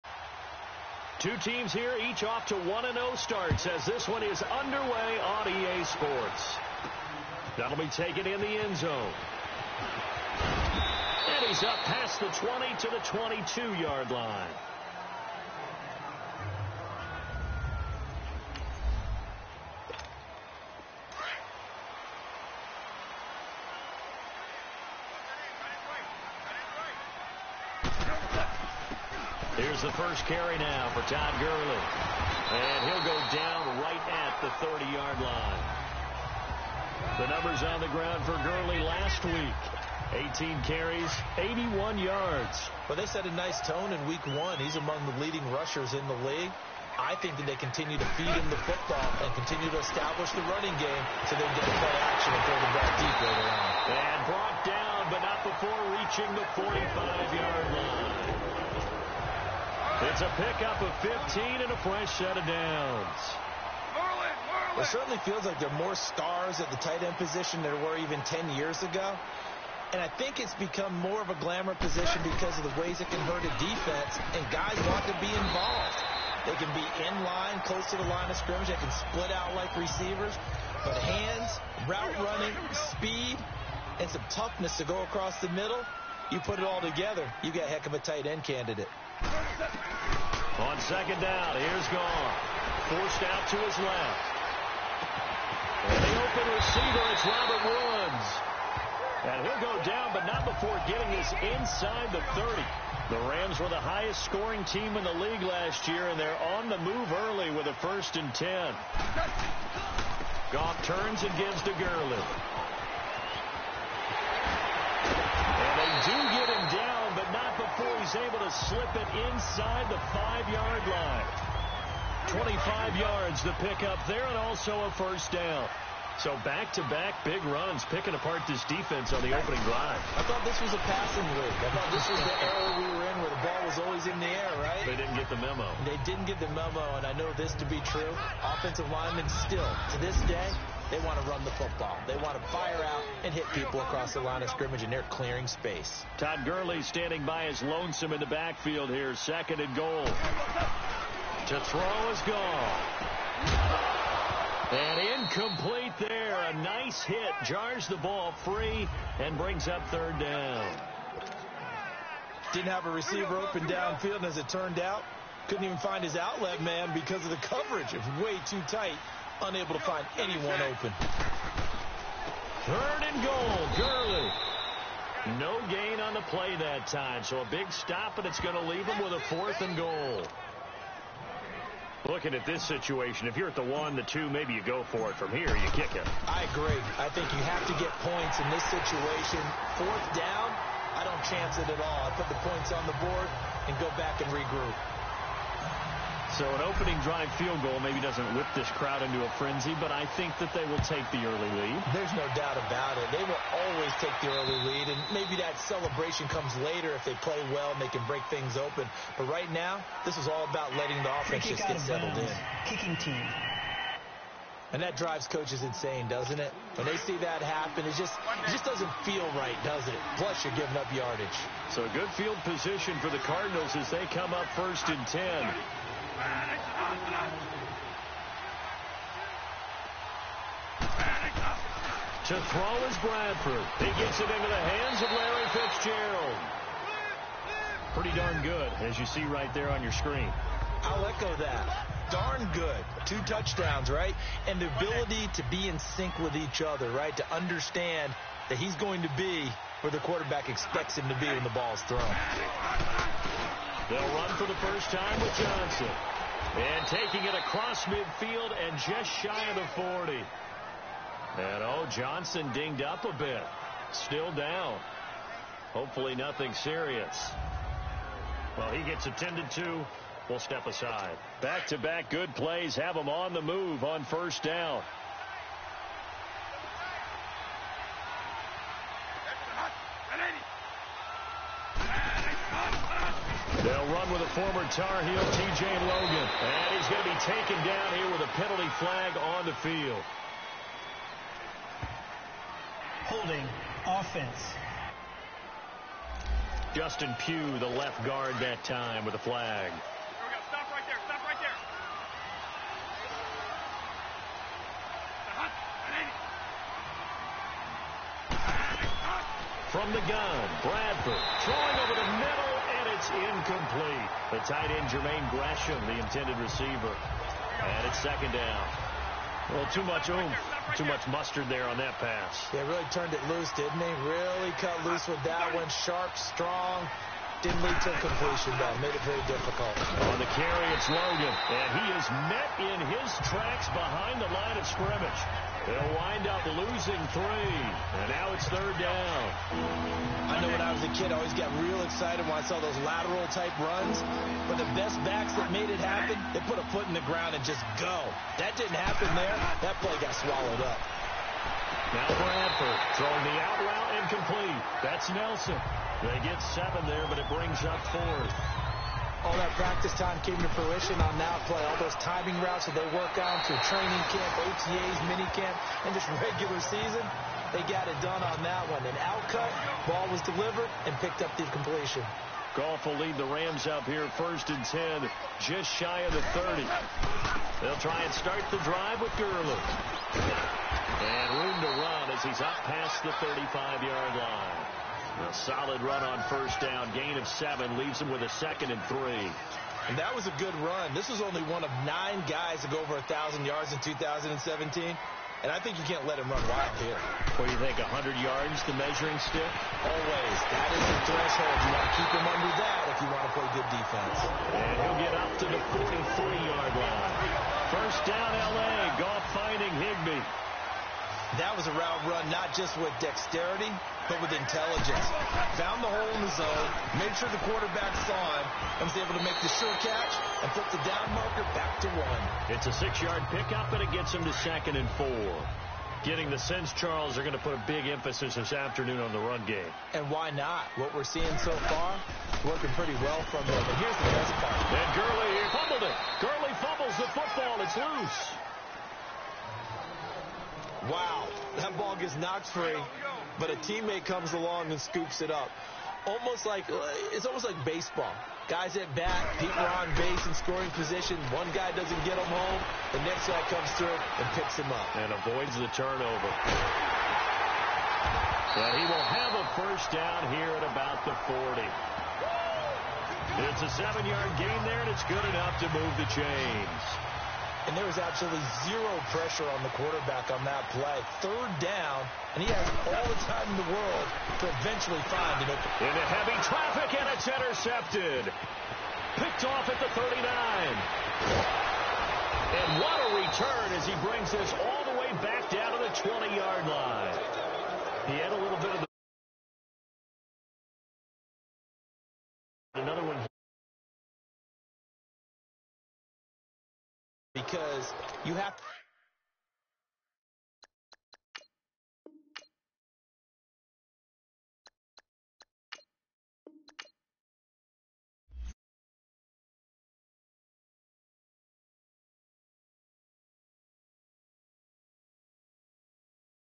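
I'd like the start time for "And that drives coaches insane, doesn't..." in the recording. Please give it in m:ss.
3:34.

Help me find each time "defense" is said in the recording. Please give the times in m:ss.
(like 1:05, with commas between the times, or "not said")
1:13, 2:08, 6:43.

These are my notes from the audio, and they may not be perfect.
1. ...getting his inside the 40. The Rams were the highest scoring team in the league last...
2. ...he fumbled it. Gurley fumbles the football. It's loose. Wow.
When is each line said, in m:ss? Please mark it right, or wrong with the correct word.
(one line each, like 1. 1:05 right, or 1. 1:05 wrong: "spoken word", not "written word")
1. 1:40 wrong: "30", not "40"
2. 7:15 right.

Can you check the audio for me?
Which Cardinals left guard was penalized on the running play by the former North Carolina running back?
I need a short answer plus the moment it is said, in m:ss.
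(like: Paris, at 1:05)
Justin Pugh, at 4:56.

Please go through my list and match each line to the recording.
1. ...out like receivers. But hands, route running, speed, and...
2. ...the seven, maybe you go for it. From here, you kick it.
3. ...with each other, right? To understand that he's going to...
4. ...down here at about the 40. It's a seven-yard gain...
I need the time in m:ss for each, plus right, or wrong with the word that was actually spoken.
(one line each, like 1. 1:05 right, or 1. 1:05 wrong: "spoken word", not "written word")
1. 1:19 right
2. 3:03 wrong: "two", not "seven"
3. 4:06 right
4. 7:39 right.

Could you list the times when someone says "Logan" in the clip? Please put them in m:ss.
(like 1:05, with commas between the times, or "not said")
4:45, 5:30.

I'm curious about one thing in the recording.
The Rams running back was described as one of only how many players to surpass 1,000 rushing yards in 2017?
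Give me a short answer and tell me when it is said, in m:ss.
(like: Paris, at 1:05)
9, at 6:31.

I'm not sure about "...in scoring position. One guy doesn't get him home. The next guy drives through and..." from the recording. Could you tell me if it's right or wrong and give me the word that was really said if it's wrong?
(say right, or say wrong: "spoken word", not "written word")
wrong: "comes", not "drives".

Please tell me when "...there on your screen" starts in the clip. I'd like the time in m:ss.
3:59.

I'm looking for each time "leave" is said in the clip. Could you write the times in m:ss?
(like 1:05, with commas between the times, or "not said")
2:58, 6:27.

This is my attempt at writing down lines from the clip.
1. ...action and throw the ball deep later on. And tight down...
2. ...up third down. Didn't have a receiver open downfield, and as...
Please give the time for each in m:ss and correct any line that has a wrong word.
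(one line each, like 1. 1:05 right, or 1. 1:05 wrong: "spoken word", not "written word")
1. 0:52 wrong: "brought", not "tight"
2. 2:39 right.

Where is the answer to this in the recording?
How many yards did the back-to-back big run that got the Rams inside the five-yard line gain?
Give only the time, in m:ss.
2:02.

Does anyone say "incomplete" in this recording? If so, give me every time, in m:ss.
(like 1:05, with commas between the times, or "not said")
2:35, 5:13, 5:54.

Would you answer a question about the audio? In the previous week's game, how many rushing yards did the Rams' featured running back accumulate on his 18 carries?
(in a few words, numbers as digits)
81.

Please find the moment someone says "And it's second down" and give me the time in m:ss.
5:17.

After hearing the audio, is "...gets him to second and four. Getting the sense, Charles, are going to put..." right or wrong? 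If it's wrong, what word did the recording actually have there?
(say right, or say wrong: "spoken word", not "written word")
right.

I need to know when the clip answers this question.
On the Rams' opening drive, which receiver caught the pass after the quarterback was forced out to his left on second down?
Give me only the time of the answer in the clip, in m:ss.
1:37.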